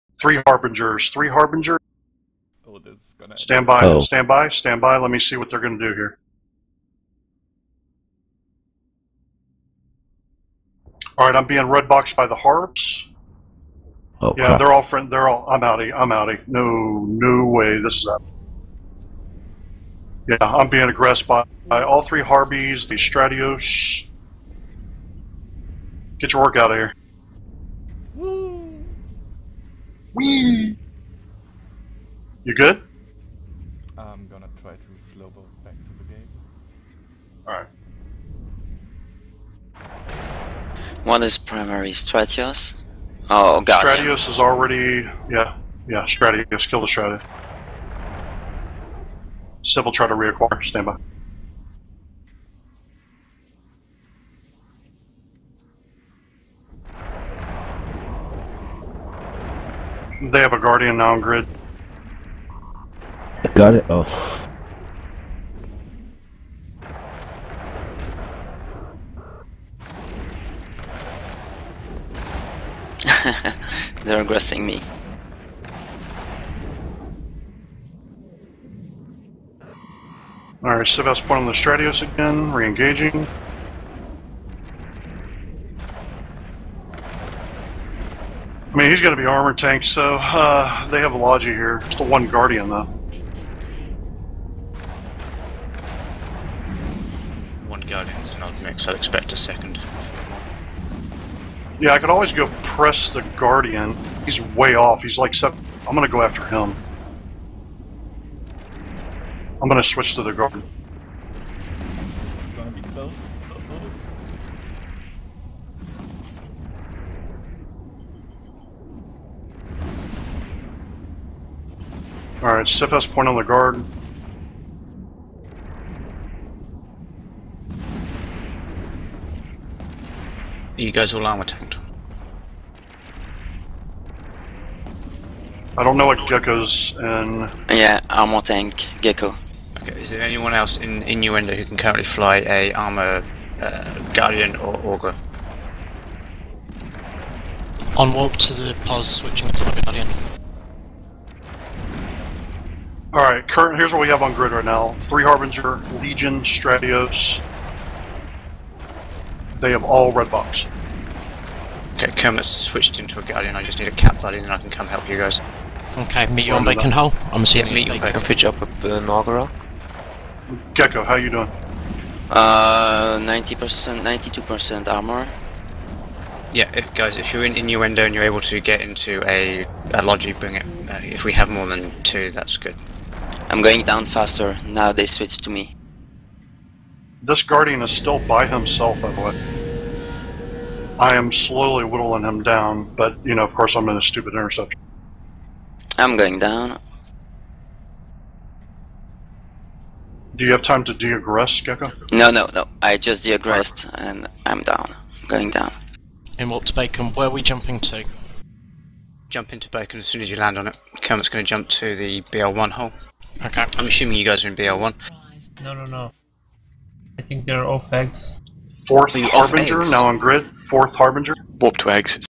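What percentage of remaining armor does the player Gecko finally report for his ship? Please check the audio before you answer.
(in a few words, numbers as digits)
92%.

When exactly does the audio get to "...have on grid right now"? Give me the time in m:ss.
2:34.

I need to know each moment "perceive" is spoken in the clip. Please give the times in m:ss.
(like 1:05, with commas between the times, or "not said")
not said.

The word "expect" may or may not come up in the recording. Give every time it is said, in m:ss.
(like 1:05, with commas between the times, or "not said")
1:38.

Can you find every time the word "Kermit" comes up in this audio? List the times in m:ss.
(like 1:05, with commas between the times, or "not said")
2:42, 3:31.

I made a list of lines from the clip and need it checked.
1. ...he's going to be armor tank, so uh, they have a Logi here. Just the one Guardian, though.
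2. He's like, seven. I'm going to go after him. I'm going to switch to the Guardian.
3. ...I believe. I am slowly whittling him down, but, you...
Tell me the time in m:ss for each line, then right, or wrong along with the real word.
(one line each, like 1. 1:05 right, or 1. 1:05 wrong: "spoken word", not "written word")
1. 1:28 right
2. 1:45 right
3. 3:09 right.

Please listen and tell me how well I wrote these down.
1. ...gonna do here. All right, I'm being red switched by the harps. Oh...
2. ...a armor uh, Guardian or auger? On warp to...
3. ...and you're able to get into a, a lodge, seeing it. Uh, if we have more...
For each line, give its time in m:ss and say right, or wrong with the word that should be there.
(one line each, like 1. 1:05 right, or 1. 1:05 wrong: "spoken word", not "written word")
1. 0:05 wrong: "boxed", not "switched"
2. 2:22 right
3. 2:58 wrong: "bring", not "seeing".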